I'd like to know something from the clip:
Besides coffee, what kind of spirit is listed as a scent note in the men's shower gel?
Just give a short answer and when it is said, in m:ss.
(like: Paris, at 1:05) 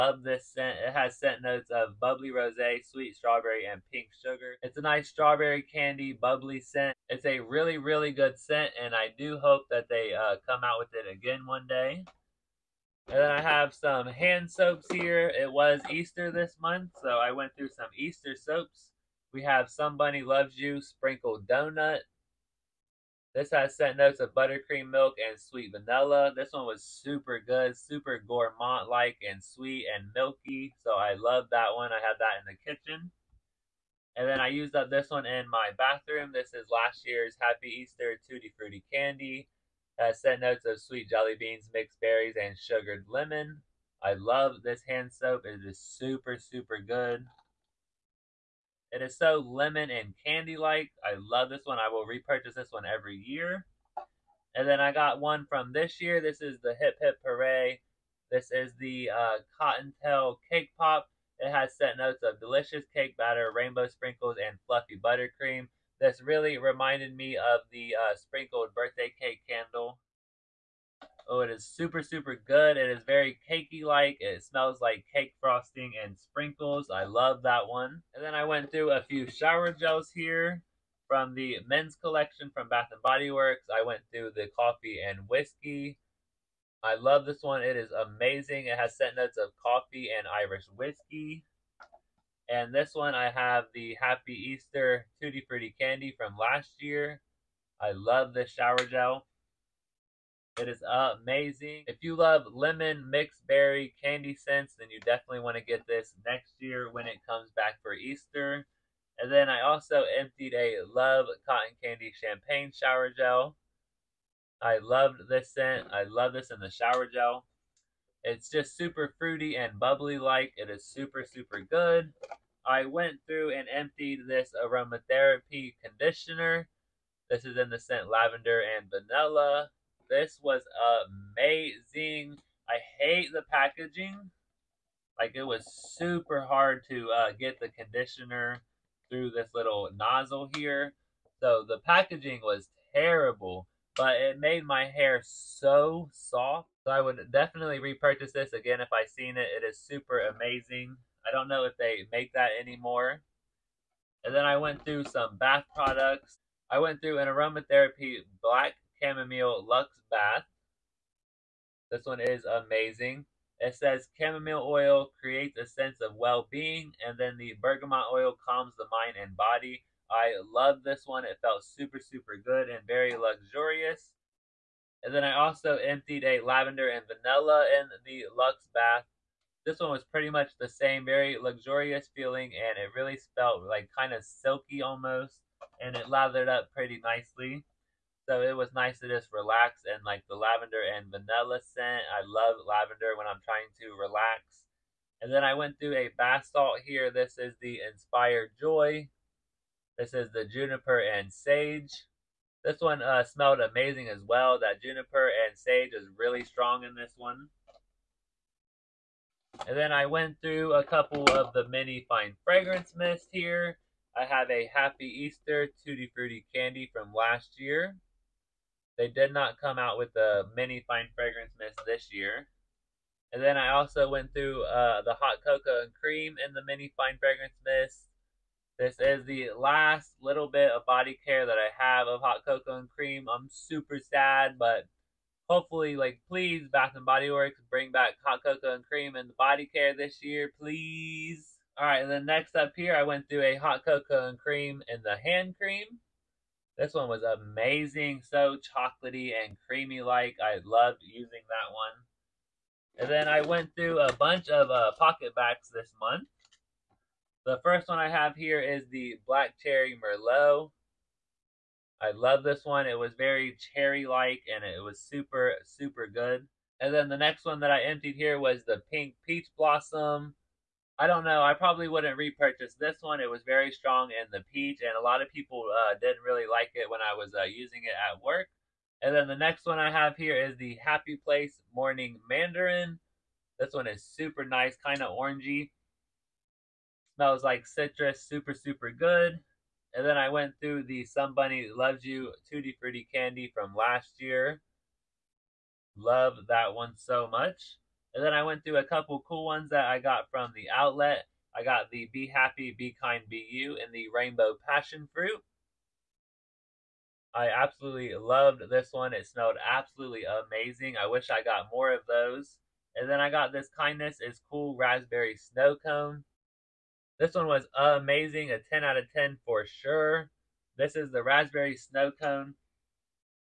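Irish whiskey, at 1:30.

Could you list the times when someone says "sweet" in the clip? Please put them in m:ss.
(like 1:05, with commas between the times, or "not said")
0:02, 0:25, 0:29, 0:40.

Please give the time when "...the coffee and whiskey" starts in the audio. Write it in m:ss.
1:24.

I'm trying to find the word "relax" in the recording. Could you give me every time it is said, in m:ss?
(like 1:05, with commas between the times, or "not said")
3:09, 3:13.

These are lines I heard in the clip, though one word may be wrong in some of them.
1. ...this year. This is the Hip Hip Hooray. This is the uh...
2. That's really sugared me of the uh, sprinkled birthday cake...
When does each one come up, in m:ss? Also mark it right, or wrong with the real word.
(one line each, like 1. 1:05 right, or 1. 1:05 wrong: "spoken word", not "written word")
1. 0:55 right
2. 1:05 wrong: "reminded", not "sugared".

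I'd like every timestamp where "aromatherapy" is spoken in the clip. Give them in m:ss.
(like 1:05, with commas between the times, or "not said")
2:04, 2:37.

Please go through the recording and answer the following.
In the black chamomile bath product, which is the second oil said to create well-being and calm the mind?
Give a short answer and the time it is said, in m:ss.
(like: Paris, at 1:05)
bergamot, at 2:47.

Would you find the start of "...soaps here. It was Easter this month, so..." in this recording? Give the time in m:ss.
0:14.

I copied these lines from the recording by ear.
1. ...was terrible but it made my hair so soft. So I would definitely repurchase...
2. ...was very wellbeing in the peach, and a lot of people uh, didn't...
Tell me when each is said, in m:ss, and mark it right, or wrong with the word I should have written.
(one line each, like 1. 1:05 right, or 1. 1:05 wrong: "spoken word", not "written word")
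1. 2:22 right
2. 4:33 wrong: "strong", not "wellbeing".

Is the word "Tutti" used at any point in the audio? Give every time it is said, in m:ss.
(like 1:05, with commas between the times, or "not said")
0:38, 1:35, 3:35, 4:52.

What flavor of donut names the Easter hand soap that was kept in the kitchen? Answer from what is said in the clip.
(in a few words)
Sprinkled Donut.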